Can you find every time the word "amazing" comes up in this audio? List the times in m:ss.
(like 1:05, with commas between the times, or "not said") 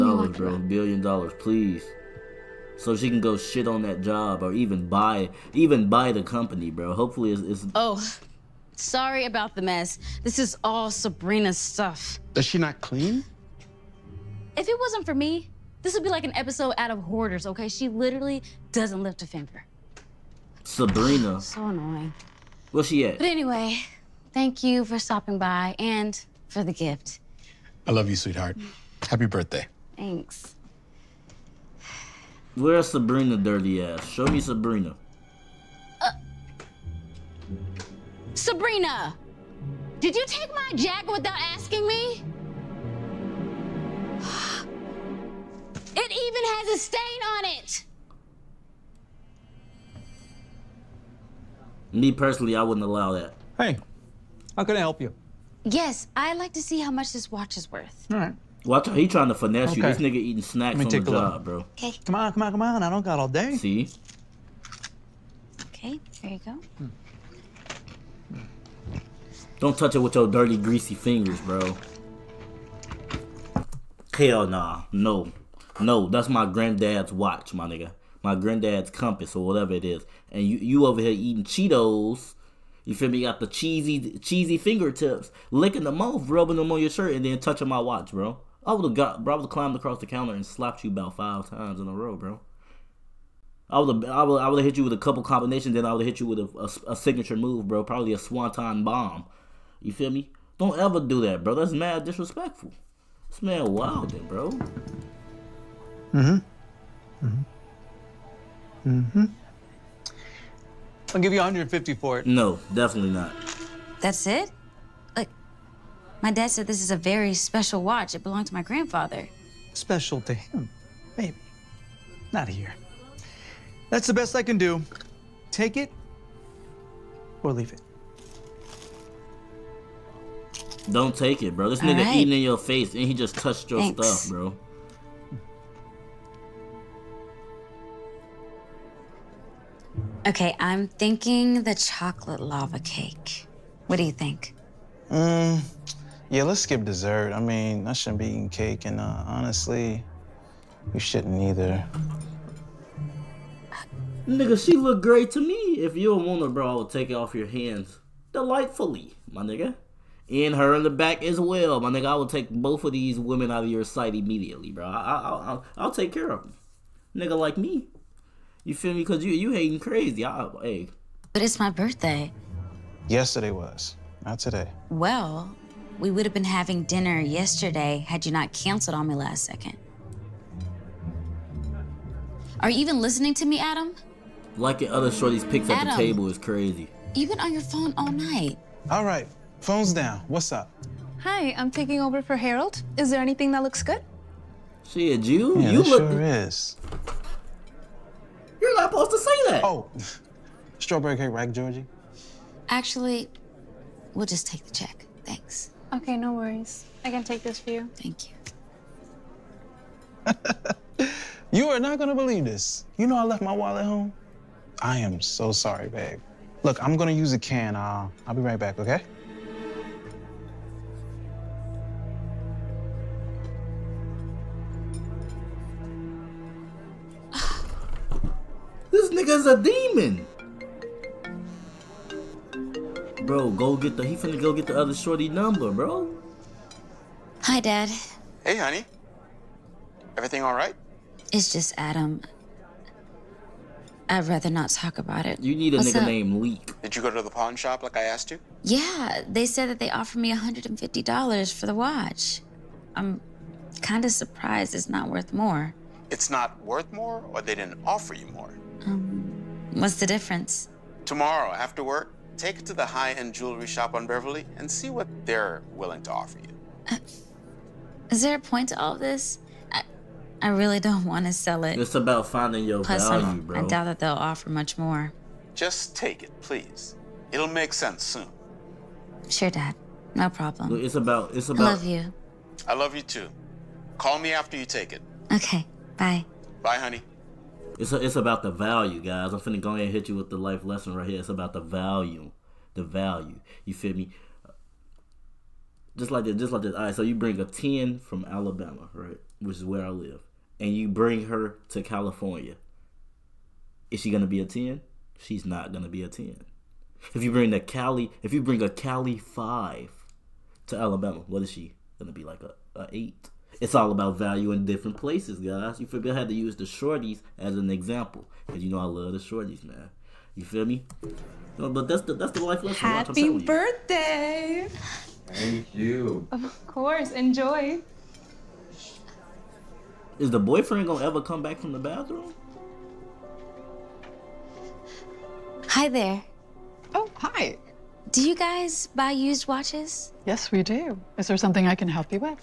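not said.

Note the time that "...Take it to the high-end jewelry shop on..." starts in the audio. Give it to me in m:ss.
4:22.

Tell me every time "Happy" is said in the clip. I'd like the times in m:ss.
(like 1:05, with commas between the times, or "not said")
0:29, 5:22.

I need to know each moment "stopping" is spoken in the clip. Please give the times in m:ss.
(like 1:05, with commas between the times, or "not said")
0:24.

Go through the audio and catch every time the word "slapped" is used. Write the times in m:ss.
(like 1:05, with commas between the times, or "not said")
1:30.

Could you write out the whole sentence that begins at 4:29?
I, I really don't want to sell it.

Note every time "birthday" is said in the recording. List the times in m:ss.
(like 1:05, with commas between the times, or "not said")
0:29, 2:51, 5:23.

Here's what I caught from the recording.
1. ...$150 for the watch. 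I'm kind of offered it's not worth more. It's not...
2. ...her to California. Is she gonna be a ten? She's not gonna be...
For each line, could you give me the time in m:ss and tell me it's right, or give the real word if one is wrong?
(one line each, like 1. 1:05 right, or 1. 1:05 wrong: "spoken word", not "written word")
1. 4:10 wrong: "surprised", not "offered"
2. 5:01 right.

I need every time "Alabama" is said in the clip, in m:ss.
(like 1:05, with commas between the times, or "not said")
4:58, 5:10.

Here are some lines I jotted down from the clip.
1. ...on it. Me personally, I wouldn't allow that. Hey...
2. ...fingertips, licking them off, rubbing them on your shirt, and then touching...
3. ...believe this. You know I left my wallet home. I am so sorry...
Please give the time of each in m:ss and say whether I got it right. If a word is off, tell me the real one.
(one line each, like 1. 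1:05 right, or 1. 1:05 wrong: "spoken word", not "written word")
1. 0:47 right
2. 1:24 right
3. 3:32 right.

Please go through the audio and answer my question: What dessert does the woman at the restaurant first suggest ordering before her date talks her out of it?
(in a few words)
Chocolate lava cake.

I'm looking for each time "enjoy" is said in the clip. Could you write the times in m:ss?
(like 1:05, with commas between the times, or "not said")
5:27.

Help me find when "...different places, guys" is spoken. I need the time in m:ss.
5:14.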